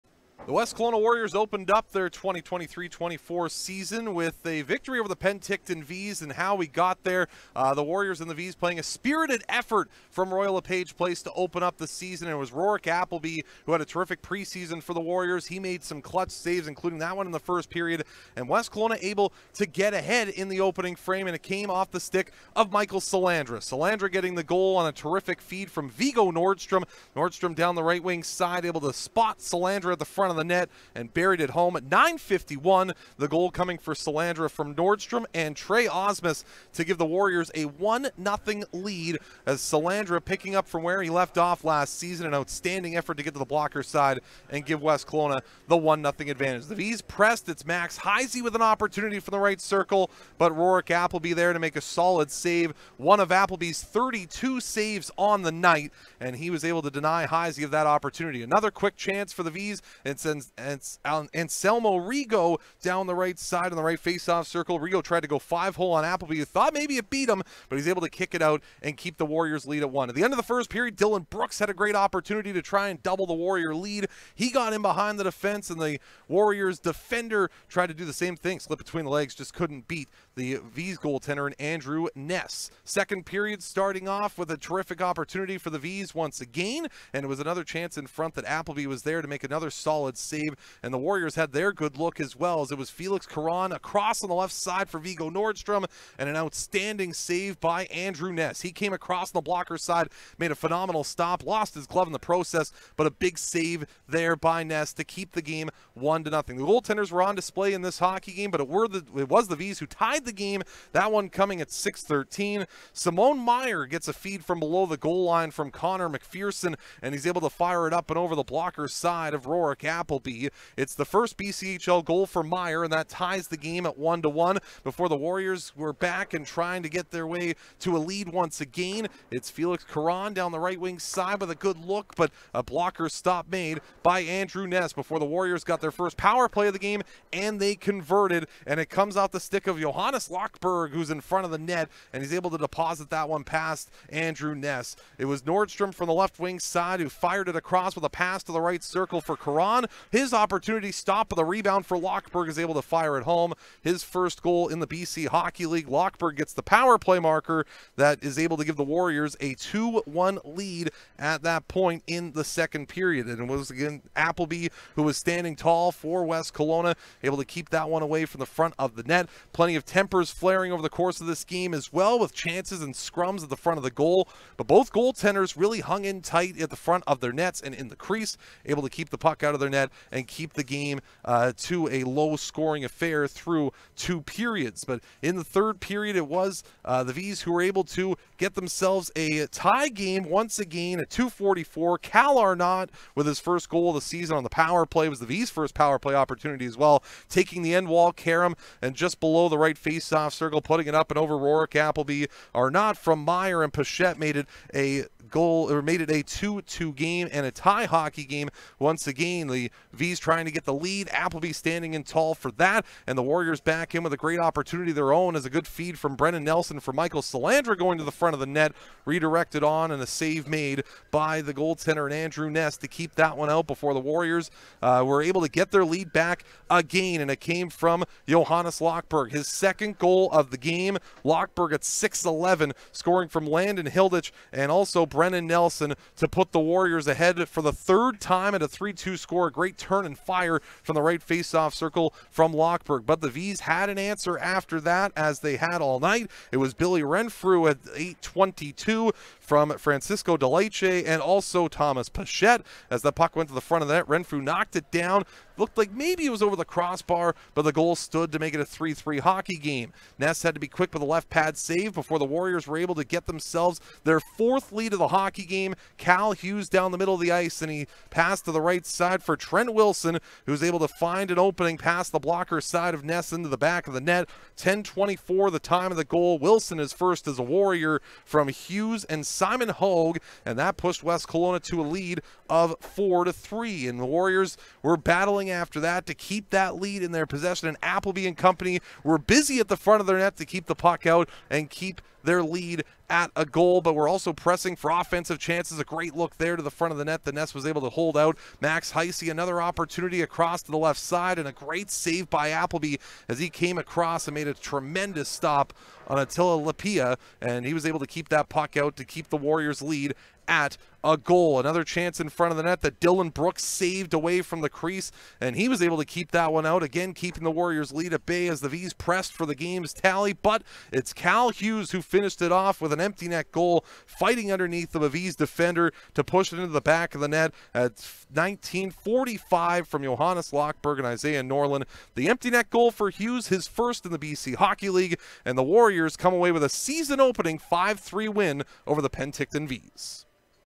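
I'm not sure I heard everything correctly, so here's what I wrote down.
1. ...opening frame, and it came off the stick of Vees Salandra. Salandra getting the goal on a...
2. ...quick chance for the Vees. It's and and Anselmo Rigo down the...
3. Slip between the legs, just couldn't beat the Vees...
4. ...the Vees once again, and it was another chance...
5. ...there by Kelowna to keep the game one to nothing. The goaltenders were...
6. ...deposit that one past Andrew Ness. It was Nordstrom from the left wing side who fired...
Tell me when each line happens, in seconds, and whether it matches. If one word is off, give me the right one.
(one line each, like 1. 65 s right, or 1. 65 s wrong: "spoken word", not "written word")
1. 20 s wrong: "Michael", not "Vees"
2. 58 s right
3. 78 s right
4. 85 s right
5. 104 s wrong: "Ness", not "Kelowna"
6. 142 s right.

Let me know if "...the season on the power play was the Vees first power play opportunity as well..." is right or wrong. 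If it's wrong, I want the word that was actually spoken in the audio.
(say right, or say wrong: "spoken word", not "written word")
right.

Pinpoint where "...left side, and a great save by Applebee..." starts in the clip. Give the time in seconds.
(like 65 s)
300 s.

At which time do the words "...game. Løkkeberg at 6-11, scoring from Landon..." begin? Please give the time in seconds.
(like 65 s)
230 s.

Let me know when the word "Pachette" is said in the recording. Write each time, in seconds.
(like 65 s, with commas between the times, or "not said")
203 s, 252 s.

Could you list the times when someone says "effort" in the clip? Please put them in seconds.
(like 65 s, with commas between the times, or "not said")
9 s, 42 s.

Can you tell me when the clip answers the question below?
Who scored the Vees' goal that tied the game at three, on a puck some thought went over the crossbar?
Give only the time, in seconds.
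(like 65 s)
246 s.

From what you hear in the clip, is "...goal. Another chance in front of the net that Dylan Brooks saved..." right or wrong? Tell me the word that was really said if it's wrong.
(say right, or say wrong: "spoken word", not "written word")
right.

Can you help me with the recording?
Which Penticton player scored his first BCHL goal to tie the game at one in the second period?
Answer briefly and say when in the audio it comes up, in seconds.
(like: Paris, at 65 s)
Simone Meyer, at 112 s.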